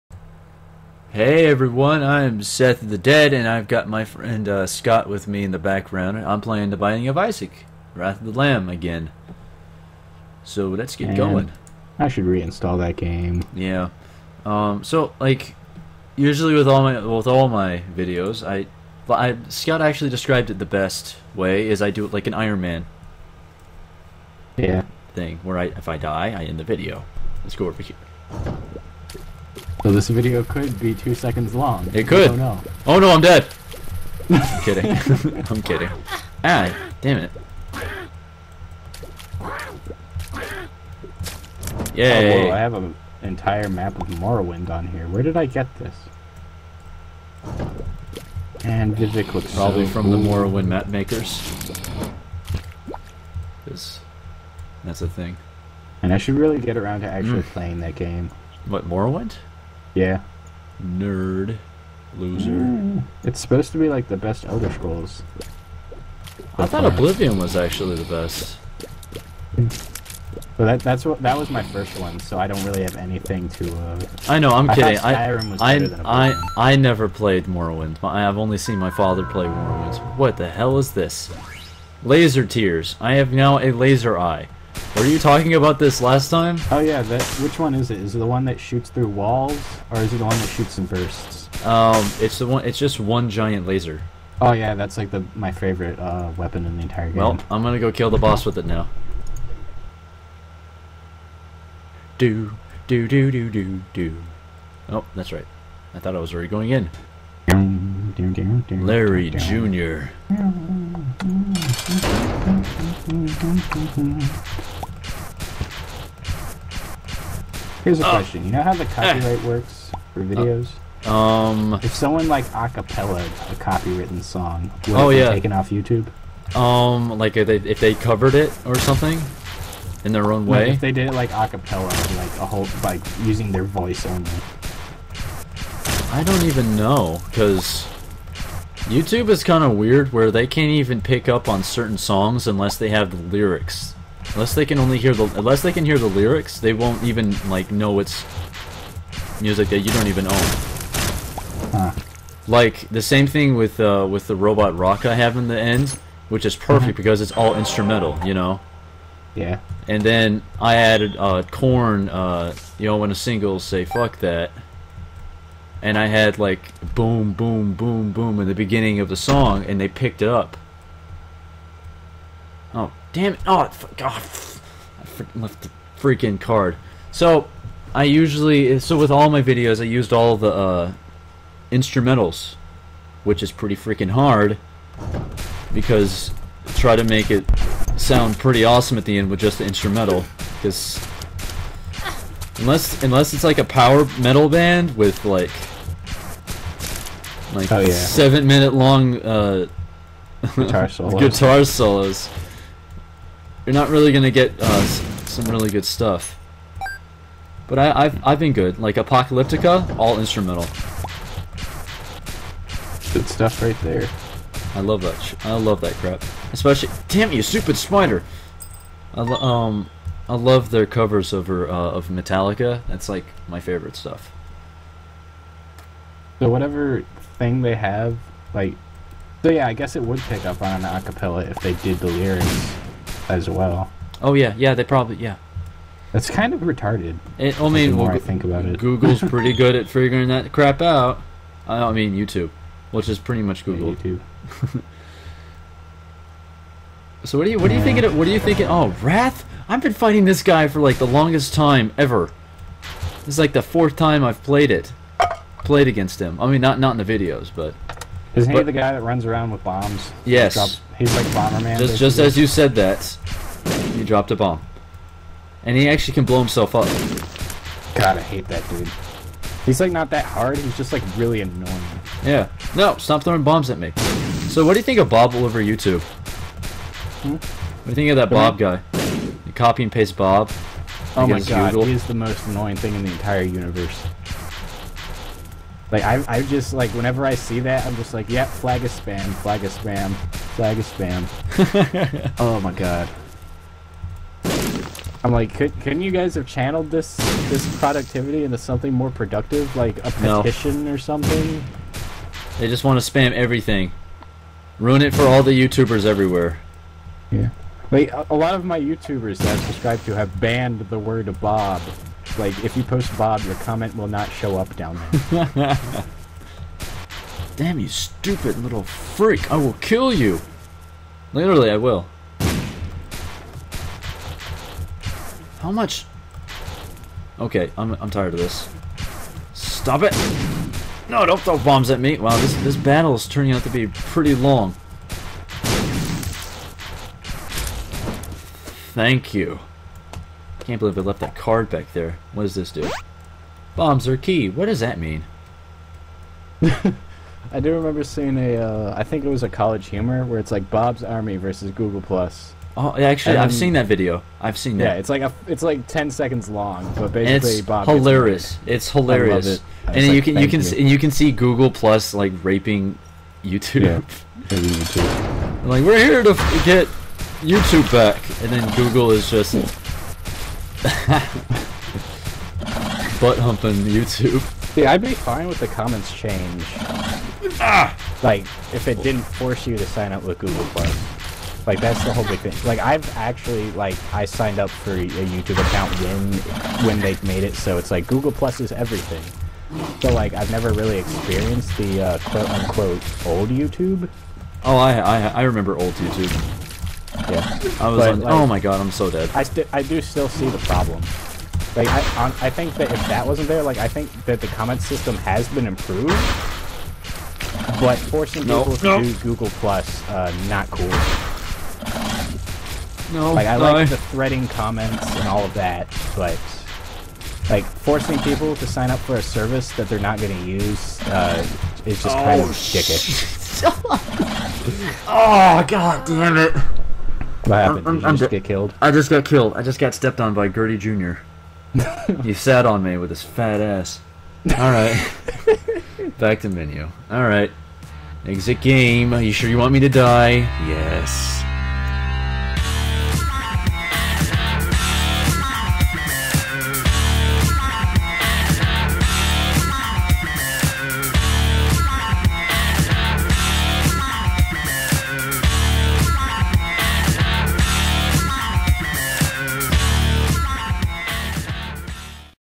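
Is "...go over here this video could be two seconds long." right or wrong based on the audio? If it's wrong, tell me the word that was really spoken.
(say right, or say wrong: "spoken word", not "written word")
right.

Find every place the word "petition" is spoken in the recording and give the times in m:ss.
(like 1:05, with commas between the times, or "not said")
5:00.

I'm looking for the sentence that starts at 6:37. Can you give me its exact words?
I was like, like, oh my god, I'm so dead.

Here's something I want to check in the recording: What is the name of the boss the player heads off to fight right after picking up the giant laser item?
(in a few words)
Larry Jr.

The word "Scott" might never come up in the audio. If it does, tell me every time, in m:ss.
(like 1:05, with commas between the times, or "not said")
0:04, 0:19.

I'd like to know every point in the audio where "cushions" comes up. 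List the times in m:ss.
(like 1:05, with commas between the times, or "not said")
not said.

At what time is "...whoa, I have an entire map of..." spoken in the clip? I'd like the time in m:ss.
0:42.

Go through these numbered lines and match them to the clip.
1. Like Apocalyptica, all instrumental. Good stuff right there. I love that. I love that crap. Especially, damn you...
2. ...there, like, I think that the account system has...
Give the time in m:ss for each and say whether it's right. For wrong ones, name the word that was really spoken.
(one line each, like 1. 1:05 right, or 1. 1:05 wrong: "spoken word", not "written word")
1. 3:28 right
2. 6:43 wrong: "comment", not "account".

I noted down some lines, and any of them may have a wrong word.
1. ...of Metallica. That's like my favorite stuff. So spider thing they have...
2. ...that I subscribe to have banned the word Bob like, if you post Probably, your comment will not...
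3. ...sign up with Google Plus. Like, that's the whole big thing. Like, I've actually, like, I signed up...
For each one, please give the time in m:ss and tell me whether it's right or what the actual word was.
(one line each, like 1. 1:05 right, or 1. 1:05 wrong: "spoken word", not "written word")
1. 3:41 wrong: "whatever", not "spider"
2. 5:09 wrong: "Bob", not "Probably"
3. 6:19 right.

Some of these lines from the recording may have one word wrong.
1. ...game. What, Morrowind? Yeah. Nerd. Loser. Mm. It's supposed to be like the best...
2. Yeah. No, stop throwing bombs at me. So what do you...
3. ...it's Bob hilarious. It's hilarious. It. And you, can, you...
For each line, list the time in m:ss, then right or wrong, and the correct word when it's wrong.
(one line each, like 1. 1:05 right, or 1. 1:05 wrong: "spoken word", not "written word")
1. 0:57 right
2. 4:32 right
3. 5:57 right.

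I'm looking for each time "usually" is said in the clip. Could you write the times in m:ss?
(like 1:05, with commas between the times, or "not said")
0:16, 2:58.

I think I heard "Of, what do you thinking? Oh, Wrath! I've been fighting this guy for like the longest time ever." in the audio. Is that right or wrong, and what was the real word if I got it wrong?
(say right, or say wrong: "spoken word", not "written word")
right.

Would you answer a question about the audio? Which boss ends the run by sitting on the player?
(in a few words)
Gurdy Jr.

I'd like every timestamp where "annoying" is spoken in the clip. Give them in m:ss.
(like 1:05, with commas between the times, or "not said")
4:31, 4:42.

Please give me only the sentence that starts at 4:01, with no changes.
I mean, YouTube, which is pretty much Google.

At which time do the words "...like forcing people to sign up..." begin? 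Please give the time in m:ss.
6:57.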